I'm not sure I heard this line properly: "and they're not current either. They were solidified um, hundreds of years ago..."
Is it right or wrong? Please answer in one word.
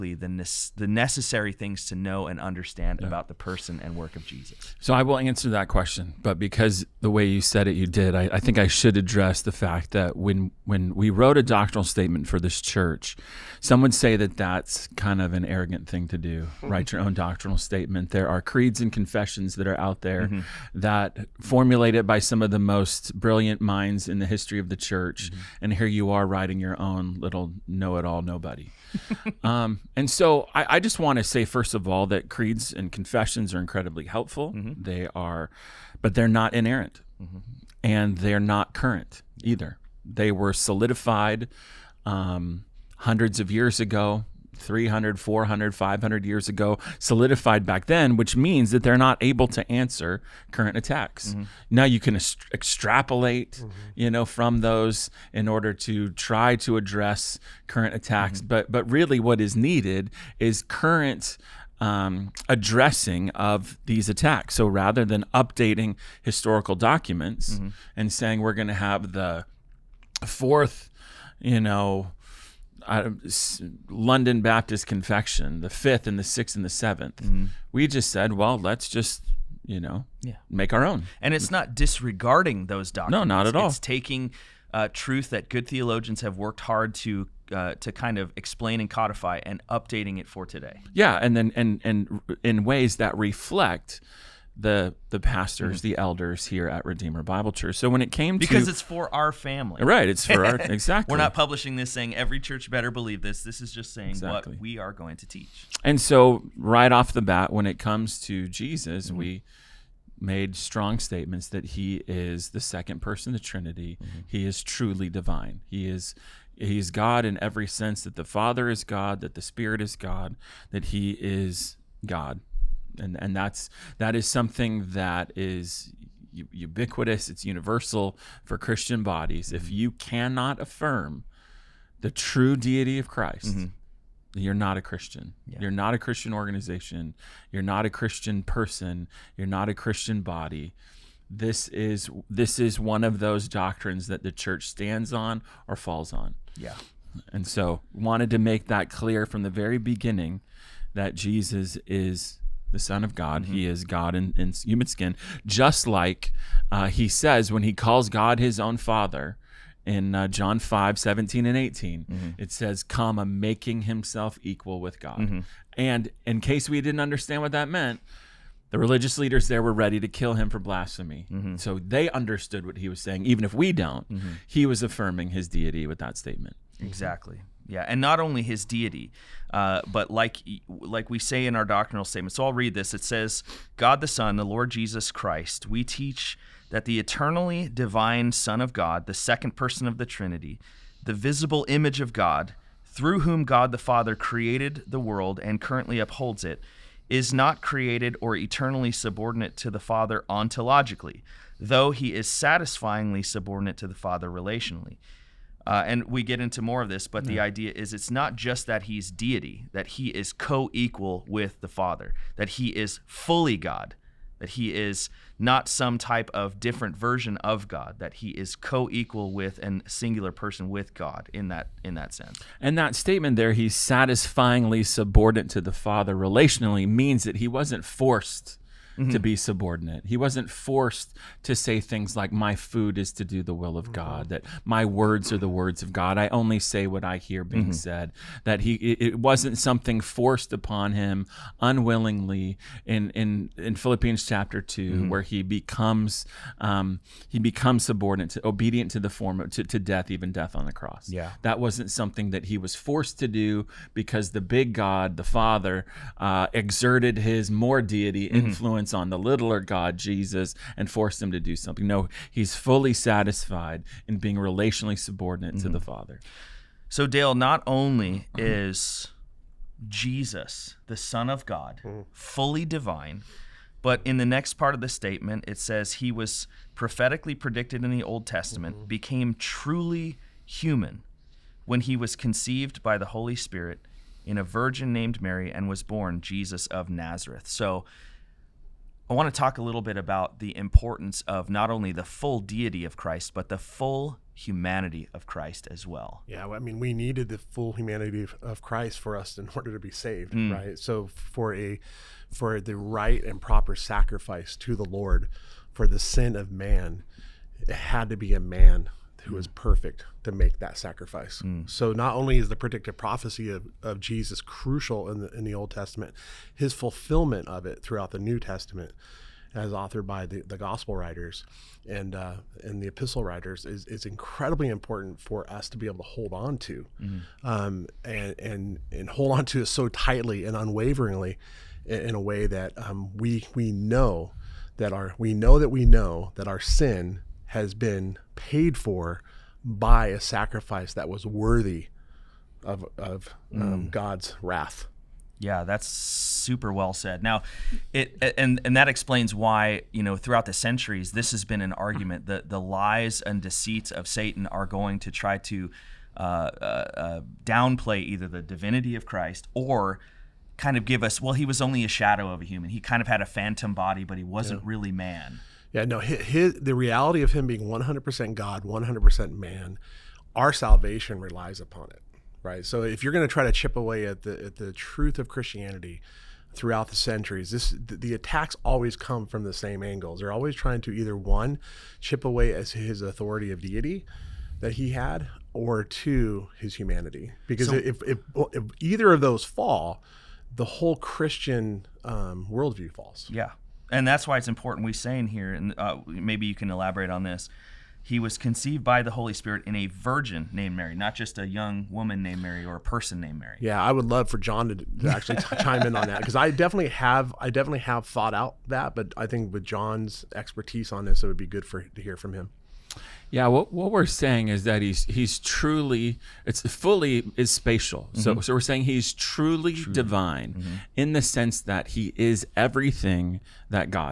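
right.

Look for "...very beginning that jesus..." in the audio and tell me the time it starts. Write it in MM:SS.
02:29.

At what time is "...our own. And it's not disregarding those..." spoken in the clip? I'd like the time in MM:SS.
01:20.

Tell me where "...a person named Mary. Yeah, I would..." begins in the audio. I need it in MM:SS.
06:42.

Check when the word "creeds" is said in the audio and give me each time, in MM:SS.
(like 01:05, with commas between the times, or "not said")
00:18, 00:32.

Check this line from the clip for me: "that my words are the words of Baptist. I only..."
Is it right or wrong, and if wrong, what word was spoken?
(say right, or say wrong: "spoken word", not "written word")
wrong: "God", not "Baptist".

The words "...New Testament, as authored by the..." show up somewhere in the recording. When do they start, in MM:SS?
05:18.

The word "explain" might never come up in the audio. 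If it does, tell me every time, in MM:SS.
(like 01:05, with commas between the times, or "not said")
01:28, 05:48.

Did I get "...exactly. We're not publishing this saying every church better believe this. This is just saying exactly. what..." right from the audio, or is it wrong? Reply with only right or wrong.
right.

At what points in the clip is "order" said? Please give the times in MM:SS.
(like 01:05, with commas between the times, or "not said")
00:55, 04:59.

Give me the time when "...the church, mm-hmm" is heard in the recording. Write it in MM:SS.
00:24.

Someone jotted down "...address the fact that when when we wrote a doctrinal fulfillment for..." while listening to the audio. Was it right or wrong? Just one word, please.
wrong.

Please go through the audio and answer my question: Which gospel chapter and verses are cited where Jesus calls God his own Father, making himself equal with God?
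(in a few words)
John 5:17-18.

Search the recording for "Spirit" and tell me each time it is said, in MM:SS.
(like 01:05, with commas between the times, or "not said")
01:59, 04:43, 06:39.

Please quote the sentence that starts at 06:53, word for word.
Yeah, what, what we're saying is that he's he's truly it's fully is spatial.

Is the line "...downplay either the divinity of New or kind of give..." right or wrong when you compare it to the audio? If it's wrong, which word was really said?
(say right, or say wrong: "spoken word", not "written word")
wrong: "Christ", not "New".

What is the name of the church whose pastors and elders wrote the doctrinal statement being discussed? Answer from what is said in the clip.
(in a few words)
Redeemer Bible Church.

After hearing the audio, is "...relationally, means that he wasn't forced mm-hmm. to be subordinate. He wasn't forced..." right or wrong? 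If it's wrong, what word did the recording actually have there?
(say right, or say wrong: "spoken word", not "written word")
right.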